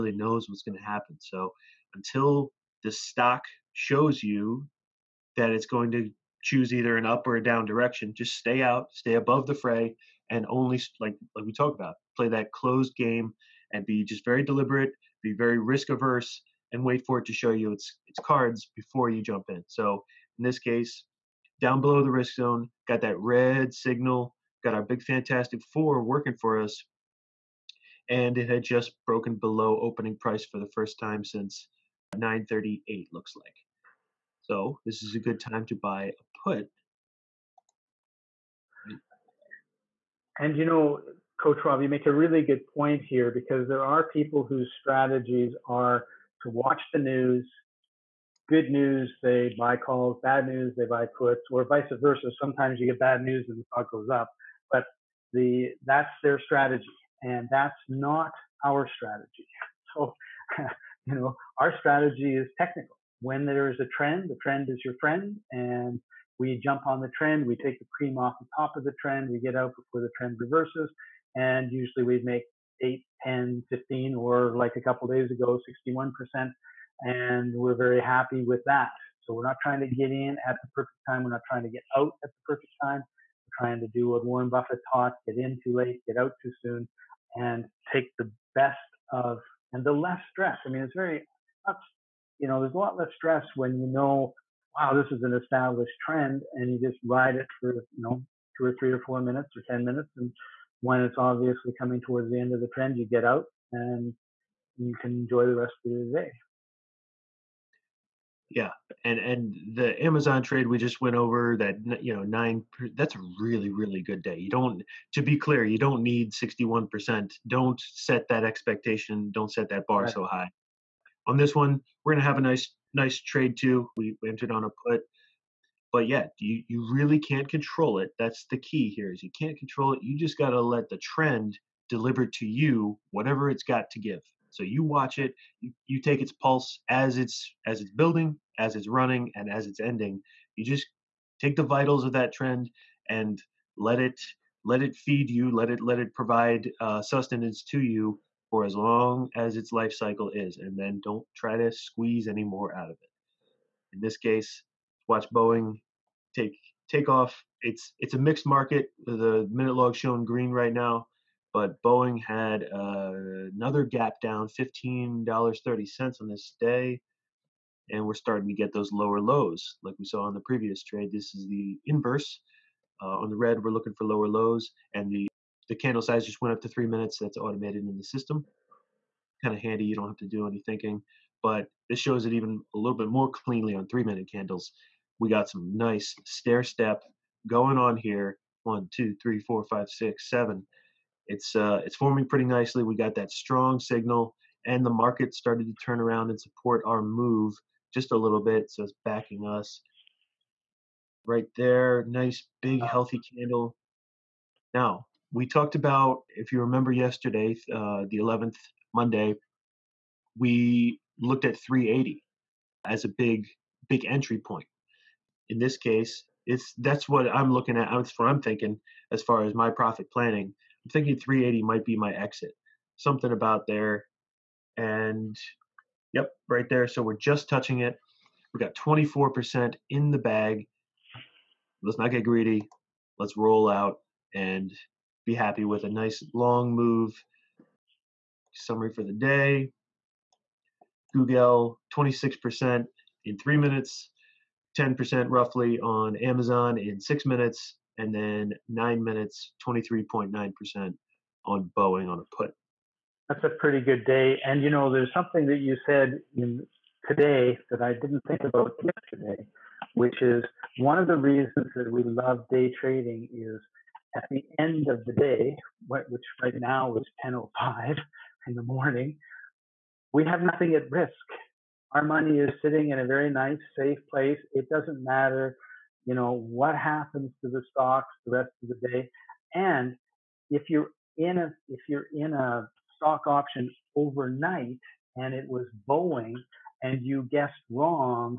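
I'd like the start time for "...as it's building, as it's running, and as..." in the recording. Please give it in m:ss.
2:17.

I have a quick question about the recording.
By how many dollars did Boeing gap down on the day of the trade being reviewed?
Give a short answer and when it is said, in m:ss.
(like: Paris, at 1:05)
$15.30, at 2:44.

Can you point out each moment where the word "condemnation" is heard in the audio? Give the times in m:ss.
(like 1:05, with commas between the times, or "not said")
not said.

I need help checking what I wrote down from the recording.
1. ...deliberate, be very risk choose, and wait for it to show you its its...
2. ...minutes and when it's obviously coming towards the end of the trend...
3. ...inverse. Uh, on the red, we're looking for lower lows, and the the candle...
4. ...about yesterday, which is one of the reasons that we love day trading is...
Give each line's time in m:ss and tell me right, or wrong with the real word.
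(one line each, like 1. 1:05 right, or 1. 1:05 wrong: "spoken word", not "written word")
1. 0:14 wrong: "averse", not "choose"
2. 1:39 right
3. 2:51 right
4. 4:18 right.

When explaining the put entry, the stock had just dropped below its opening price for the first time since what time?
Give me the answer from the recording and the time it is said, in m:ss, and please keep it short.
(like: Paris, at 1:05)
9:38, at 0:32.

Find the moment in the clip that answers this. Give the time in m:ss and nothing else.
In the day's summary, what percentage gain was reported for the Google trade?
4:01.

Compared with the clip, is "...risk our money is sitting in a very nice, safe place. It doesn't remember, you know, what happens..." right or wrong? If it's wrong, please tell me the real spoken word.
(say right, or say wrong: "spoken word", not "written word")
wrong: "matter", not "remember".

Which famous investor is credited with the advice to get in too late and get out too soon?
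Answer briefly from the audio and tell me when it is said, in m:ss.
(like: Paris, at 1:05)
Warren Buffett, at 1:24.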